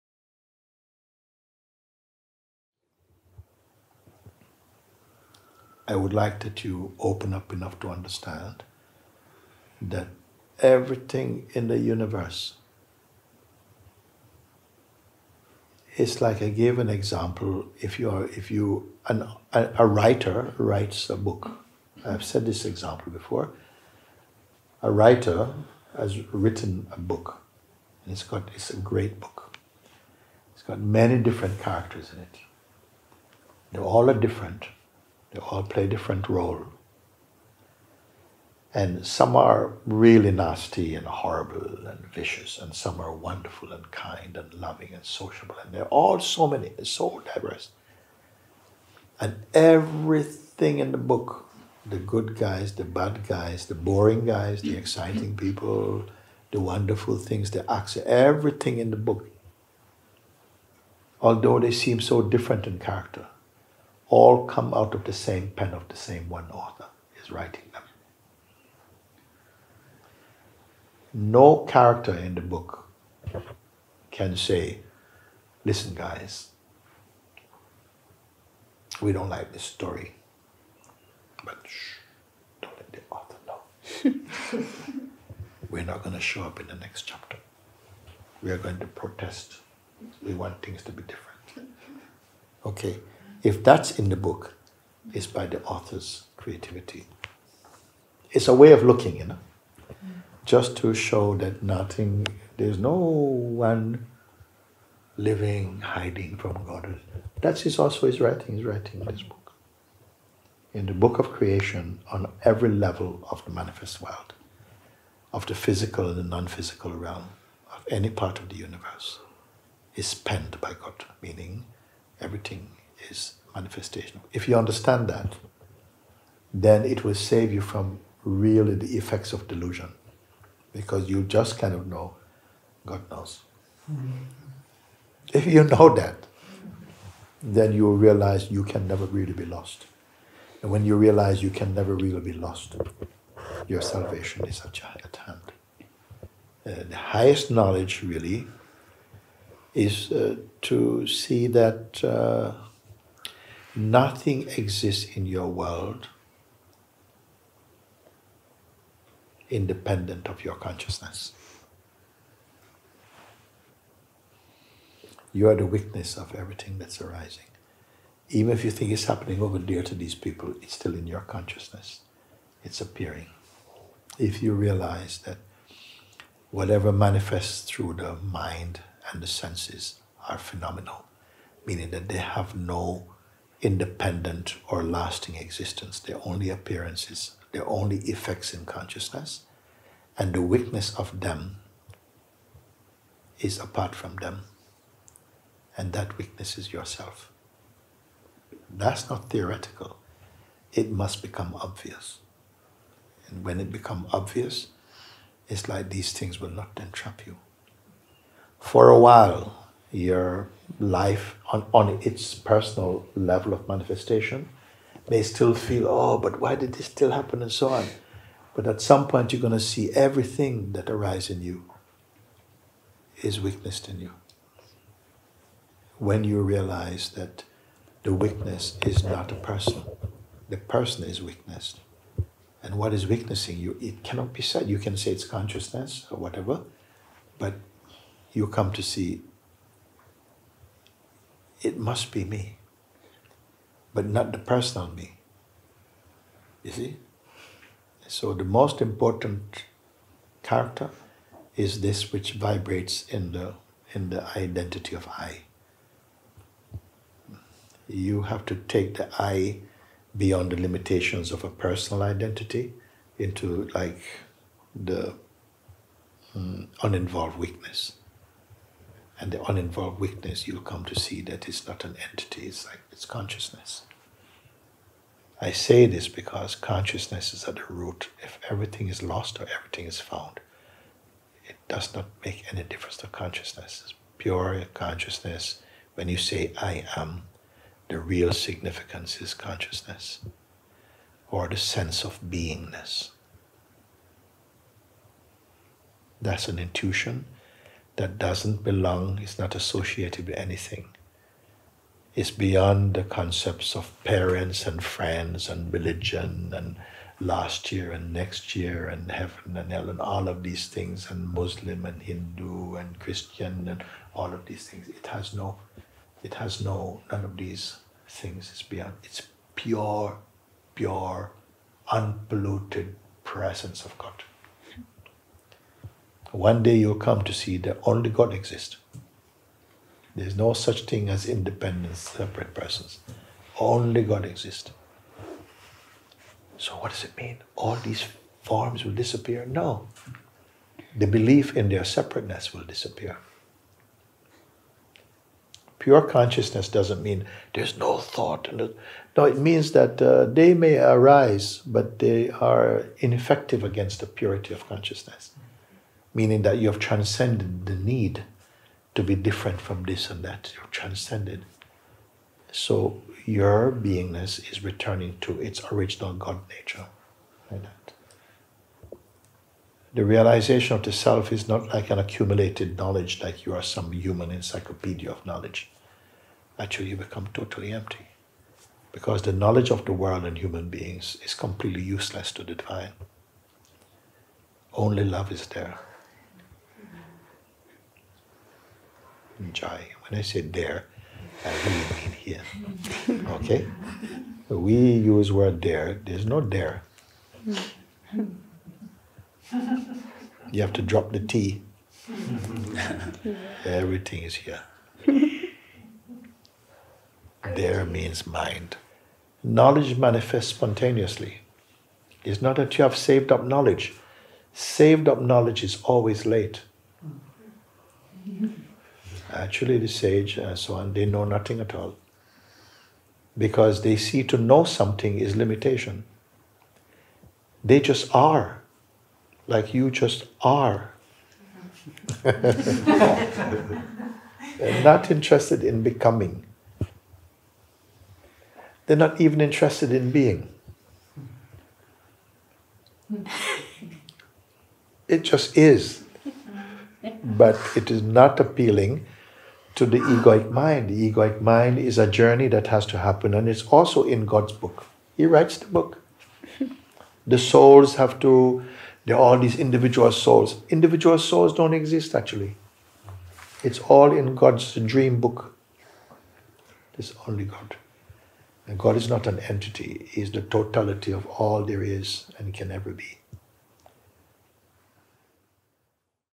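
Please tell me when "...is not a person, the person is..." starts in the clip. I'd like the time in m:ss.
3:48.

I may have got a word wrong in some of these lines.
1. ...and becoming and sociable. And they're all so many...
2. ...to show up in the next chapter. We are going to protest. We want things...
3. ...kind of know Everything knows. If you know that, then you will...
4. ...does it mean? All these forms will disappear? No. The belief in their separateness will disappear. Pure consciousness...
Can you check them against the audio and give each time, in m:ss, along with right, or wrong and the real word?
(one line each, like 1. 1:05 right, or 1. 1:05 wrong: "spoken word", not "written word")
1. 0:44 wrong: "loving", not "becoming"
2. 1:26 right
3. 2:11 wrong: "God", not "Everything"
4. 5:36 right.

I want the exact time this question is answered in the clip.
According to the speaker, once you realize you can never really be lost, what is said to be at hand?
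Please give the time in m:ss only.
2:23.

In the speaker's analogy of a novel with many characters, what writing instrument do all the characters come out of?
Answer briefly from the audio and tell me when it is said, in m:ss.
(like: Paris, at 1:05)
the same pen, at 1:05.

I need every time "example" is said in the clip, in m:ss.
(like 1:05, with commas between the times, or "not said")
0:16, 0:22.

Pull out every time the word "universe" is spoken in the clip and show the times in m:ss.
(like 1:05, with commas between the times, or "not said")
0:11, 1:58.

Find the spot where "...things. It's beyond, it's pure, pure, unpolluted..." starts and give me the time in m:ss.
5:18.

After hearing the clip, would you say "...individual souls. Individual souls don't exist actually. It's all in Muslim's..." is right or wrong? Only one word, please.
wrong.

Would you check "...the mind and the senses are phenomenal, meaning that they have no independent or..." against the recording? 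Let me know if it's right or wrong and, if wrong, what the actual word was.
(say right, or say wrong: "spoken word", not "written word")
right.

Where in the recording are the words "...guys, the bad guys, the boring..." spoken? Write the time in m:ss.
0:52.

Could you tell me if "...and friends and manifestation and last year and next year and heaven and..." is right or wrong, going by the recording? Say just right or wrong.
wrong.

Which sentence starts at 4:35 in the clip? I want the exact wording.
I say this because consciousness is at the root.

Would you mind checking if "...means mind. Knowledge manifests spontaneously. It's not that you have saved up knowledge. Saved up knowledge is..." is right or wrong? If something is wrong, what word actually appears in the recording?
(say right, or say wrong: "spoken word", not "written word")
right.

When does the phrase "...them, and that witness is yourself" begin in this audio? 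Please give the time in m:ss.
3:14.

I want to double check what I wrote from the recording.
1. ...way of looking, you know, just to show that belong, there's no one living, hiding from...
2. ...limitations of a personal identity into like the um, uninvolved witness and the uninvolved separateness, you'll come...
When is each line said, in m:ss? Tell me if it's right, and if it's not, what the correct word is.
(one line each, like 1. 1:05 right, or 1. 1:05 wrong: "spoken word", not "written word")
1. 1:38 wrong: "nothing", not "belong"
2. 4:20 wrong: "witness", not "separateness".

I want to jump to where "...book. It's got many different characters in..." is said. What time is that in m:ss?
0:29.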